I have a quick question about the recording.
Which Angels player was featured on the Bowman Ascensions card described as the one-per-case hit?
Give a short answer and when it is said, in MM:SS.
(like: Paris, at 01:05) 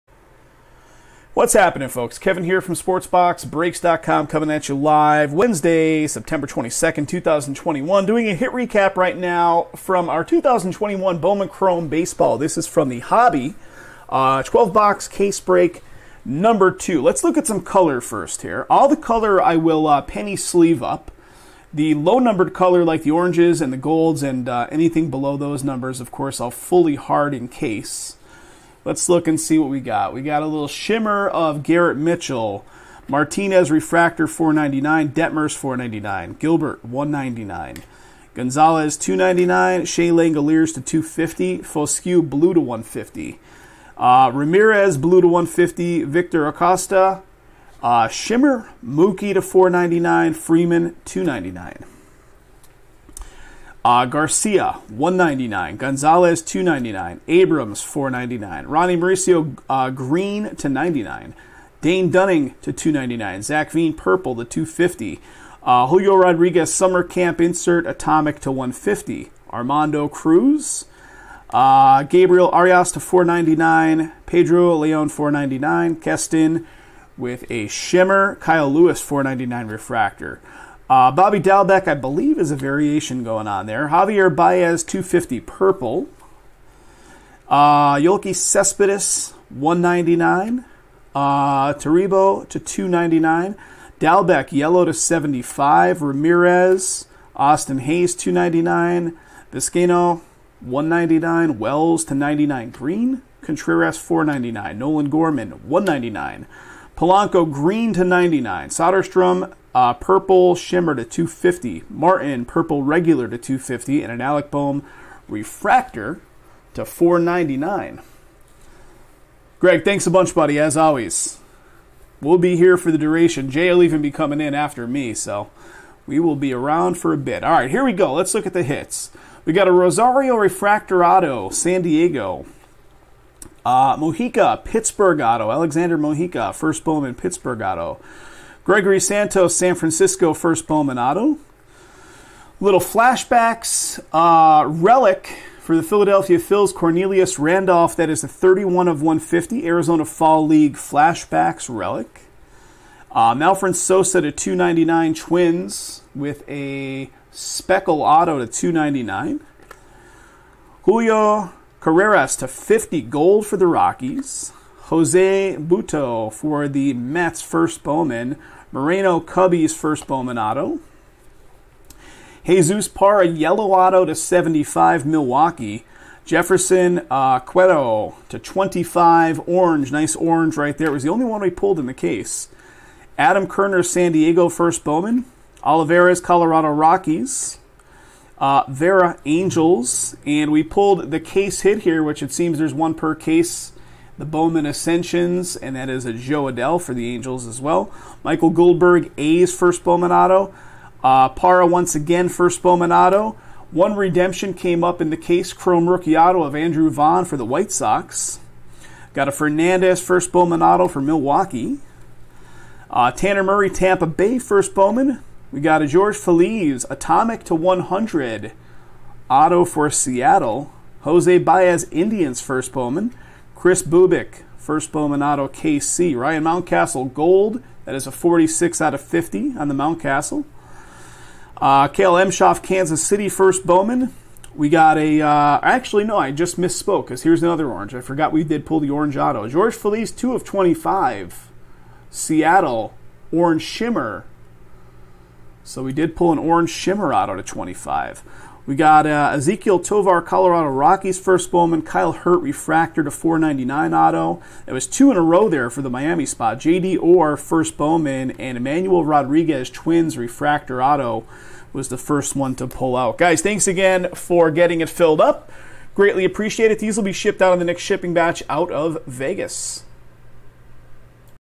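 Jo Adell, at 03:16.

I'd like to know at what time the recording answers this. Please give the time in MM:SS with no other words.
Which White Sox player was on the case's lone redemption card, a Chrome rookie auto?
03:26.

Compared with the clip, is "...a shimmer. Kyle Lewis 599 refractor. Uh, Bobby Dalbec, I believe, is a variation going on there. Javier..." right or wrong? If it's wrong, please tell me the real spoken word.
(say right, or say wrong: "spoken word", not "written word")
wrong: "499", not "599".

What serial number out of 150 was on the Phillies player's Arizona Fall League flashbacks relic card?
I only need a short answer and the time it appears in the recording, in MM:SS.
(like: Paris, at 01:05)
31, at 02:28.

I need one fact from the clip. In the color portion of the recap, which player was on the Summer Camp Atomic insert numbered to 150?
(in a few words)
Julio Rodriguez.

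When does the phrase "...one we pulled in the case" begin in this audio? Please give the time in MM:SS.
03:01.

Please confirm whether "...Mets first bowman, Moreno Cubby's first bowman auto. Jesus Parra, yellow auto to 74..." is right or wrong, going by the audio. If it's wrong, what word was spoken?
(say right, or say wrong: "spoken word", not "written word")
wrong: "75", not "74".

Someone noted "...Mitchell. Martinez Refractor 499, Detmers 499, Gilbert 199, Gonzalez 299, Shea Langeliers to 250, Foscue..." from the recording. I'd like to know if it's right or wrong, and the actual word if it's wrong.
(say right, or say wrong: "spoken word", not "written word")
right.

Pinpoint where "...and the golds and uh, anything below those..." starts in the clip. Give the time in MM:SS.
00:23.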